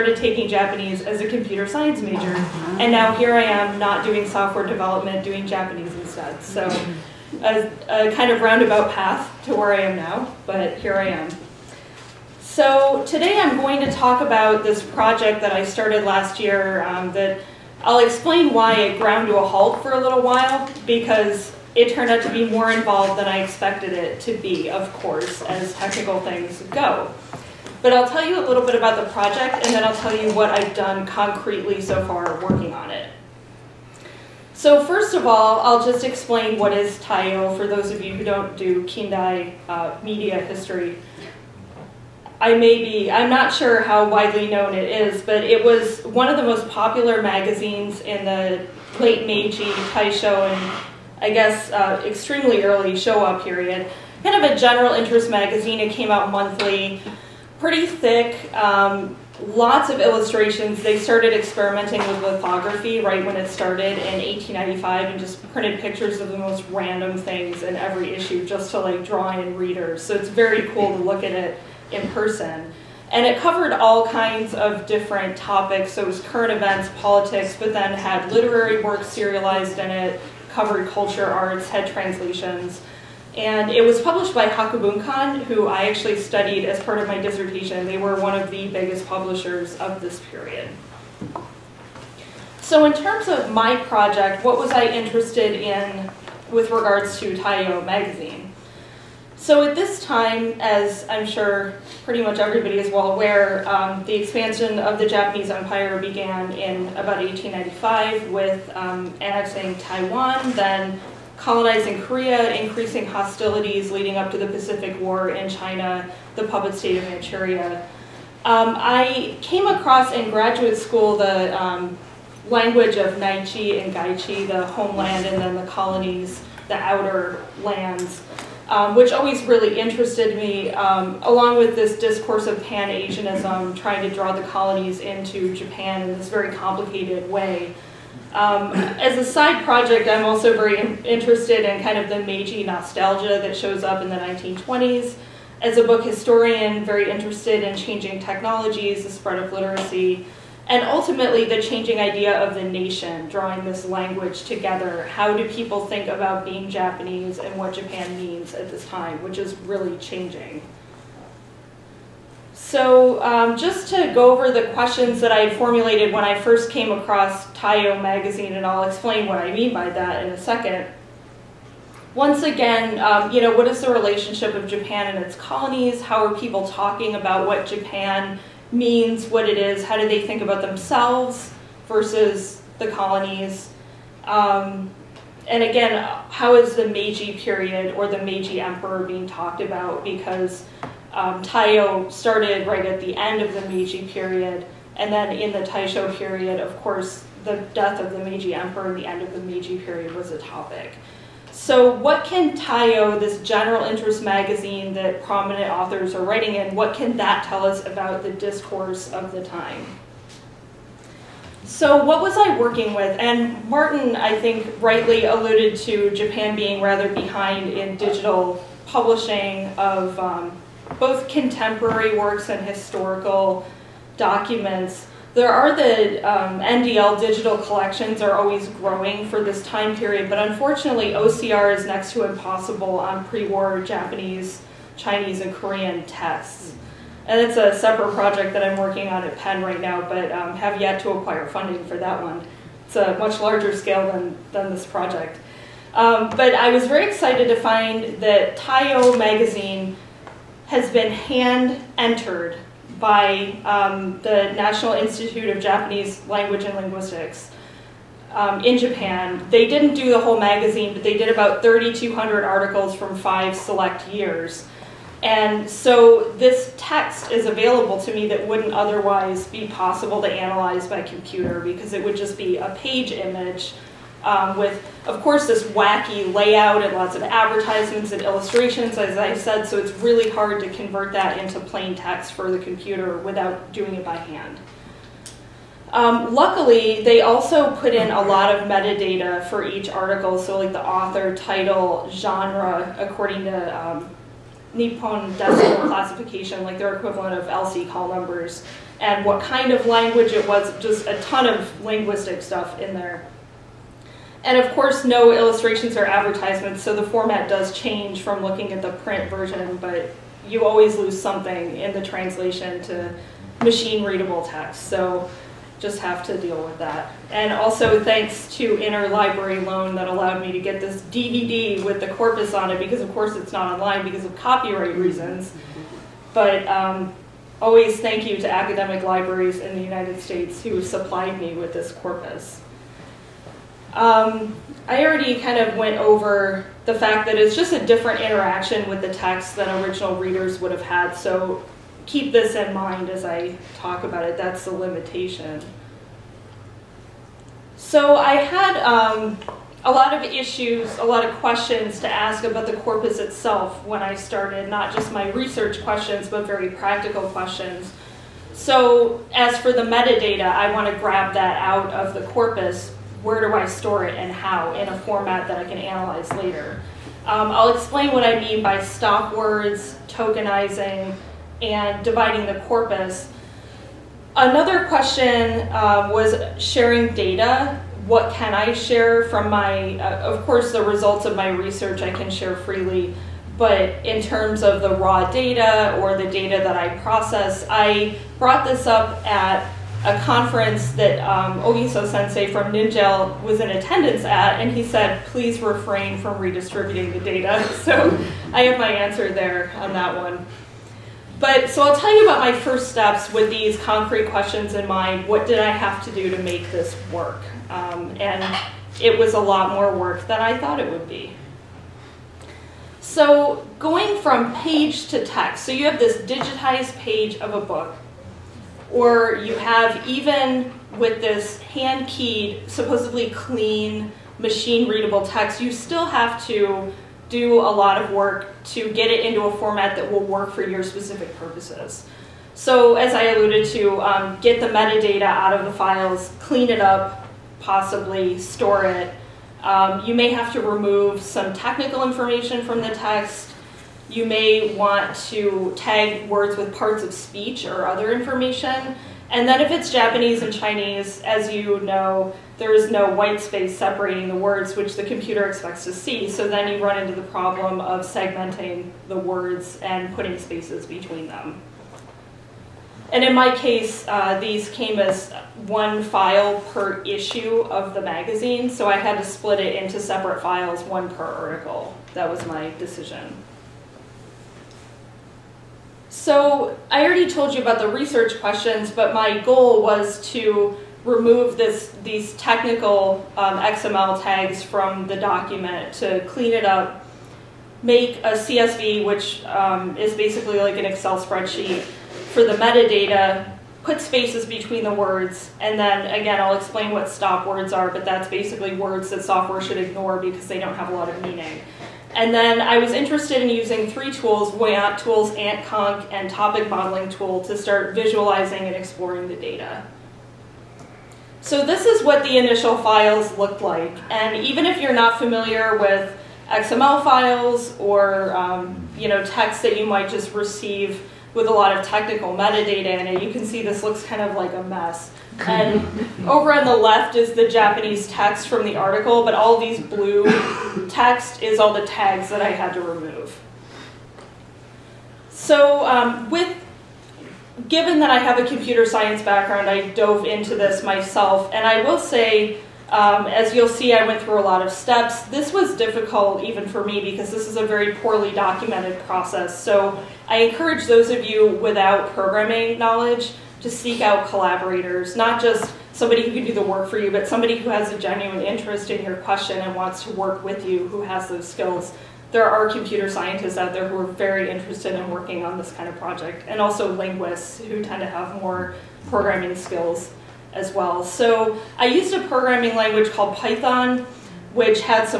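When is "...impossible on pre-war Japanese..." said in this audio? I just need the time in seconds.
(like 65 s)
232 s.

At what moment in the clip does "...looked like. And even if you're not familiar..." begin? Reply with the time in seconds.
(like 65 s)
513 s.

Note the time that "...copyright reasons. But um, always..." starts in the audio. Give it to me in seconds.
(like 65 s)
324 s.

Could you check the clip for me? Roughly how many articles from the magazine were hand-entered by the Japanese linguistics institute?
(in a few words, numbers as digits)
3,200.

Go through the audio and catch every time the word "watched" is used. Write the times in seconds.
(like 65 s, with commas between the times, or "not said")
not said.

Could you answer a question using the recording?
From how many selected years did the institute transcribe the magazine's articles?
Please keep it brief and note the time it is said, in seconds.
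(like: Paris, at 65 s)
5, at 263 s.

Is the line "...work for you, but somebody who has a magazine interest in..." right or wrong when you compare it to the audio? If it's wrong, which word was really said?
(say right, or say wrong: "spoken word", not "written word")
wrong: "genuine", not "magazine".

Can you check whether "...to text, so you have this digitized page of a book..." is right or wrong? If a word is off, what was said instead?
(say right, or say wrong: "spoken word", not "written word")
right.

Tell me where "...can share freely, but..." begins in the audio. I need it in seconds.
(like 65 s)
382 s.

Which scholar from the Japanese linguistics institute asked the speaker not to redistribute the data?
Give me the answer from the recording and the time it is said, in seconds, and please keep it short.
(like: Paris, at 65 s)
Ogiso Sensei, at 391 s.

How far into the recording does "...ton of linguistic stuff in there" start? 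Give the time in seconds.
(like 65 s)
301 s.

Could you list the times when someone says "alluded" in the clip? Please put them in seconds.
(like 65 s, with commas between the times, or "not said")
215 s, 433 s.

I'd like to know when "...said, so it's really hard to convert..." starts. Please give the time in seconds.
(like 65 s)
279 s.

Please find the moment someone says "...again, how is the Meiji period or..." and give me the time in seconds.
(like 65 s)
185 s.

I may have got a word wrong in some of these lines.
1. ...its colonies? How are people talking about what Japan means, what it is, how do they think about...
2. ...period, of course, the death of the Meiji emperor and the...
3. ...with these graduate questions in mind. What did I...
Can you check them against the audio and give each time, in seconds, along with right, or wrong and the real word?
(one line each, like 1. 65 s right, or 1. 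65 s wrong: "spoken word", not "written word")
1. 175 s right
2. 196 s right
3. 403 s wrong: "concrete", not "graduate".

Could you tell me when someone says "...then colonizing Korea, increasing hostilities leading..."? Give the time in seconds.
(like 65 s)
110 s.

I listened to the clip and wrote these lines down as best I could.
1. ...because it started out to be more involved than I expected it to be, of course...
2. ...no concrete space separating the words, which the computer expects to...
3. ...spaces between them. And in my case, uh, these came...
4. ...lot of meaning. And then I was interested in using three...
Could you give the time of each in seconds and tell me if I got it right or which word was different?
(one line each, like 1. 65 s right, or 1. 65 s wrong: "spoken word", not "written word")
1. 20 s wrong: "turned", not "started"
2. 452 s wrong: "white", not "concrete"
3. 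460 s right
4. 500 s right.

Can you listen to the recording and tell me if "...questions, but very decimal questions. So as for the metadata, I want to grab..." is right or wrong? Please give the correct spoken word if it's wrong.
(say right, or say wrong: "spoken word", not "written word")
wrong: "practical", not "decimal".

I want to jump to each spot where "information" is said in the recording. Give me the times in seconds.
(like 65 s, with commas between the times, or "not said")
442 s, 448 s.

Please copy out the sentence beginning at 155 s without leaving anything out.
How do people think about being Japanese and what Japan means at this time, which is really changing.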